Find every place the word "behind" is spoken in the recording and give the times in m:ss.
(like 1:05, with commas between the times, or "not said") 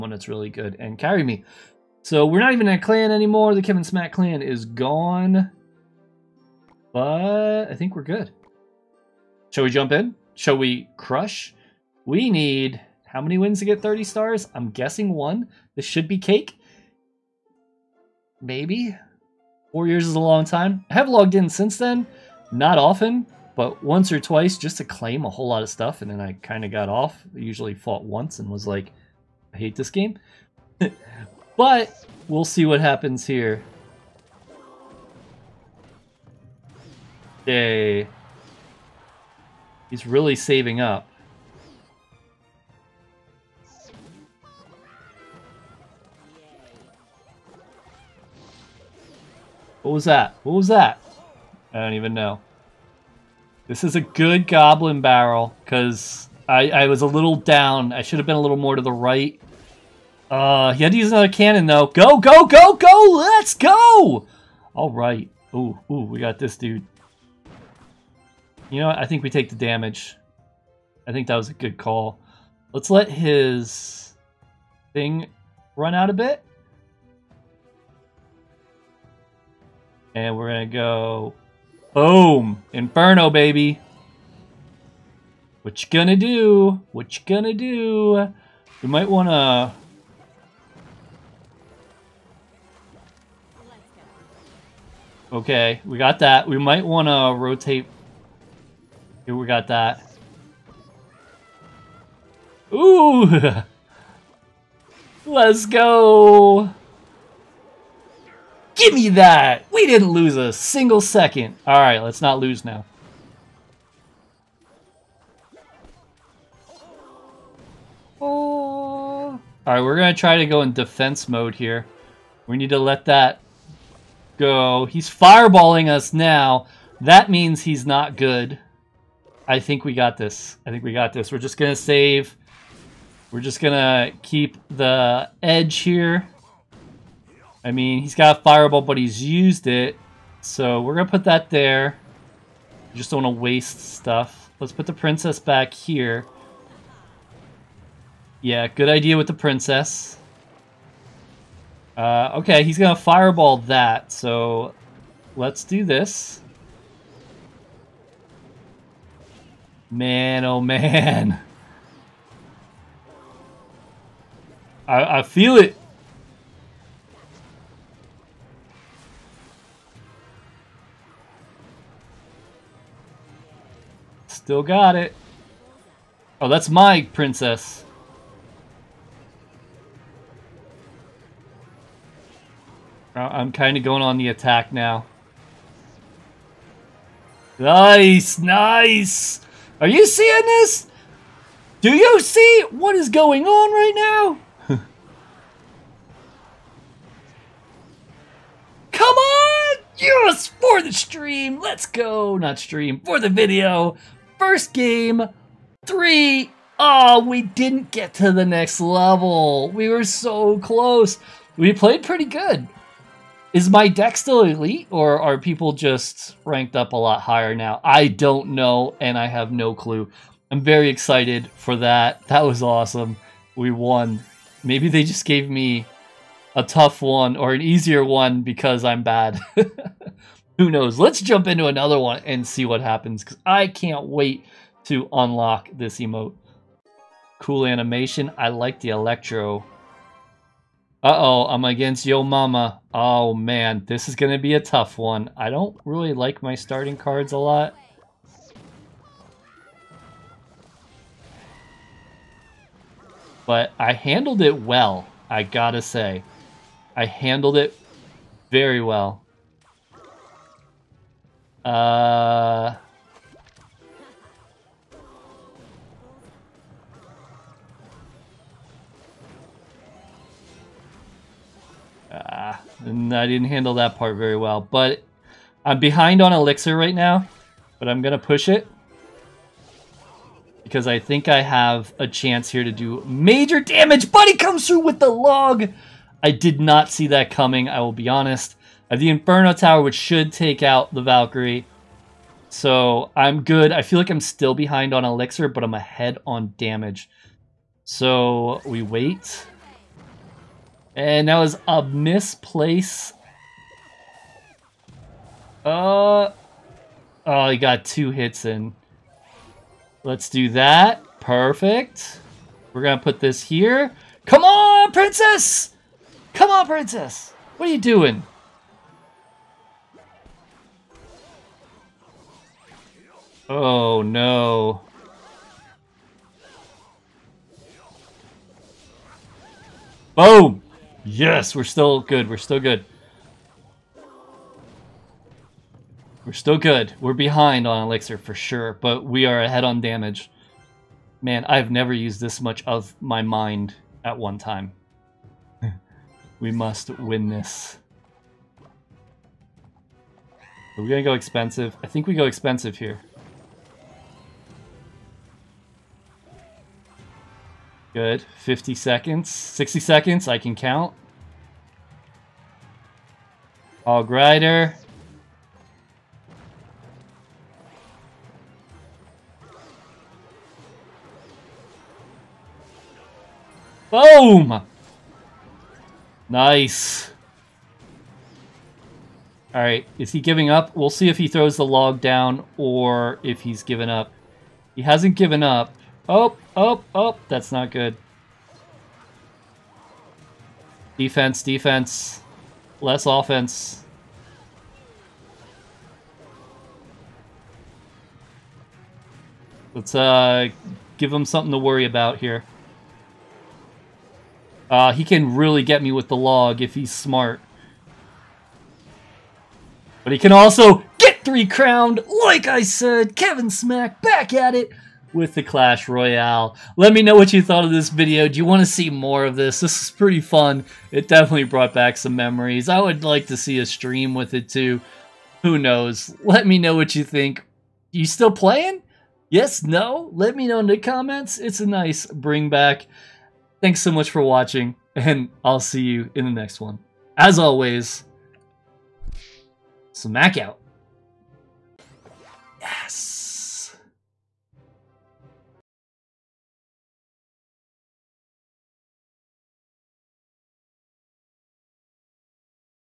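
4:35, 4:54, 5:37.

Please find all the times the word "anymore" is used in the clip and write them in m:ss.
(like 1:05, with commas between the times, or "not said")
0:03.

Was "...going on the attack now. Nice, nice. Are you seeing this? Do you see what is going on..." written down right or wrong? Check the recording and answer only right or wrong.
right.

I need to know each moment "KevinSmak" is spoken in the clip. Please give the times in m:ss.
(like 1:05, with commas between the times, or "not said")
0:03, 6:53.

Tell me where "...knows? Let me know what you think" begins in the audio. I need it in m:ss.
7:05.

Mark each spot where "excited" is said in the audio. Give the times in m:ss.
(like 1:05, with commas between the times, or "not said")
3:40.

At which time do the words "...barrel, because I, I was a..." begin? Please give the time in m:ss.
0:55.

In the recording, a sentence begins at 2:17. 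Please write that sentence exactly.
I mean, he's got fireball, but he's used it.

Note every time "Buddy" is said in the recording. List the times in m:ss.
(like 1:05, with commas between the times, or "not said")
4:44.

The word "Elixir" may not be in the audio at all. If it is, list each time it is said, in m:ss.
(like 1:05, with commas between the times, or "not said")
4:36, 4:55, 5:37.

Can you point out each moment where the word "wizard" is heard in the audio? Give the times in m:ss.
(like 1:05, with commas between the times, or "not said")
not said.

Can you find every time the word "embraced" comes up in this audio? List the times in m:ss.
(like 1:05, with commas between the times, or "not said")
not said.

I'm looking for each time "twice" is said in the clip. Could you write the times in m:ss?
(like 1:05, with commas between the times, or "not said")
0:24.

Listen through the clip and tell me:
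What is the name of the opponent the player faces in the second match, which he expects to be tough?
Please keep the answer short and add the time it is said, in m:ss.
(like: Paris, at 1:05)
Yo Mama, at 4:02.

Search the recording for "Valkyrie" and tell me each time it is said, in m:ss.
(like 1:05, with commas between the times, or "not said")
4:51.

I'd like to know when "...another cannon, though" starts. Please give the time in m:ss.
1:01.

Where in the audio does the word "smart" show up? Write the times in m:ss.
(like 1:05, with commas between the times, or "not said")
6:46.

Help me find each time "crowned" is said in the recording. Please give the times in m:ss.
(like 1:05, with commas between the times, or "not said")
6:51.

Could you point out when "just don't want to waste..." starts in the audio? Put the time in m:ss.
2:22.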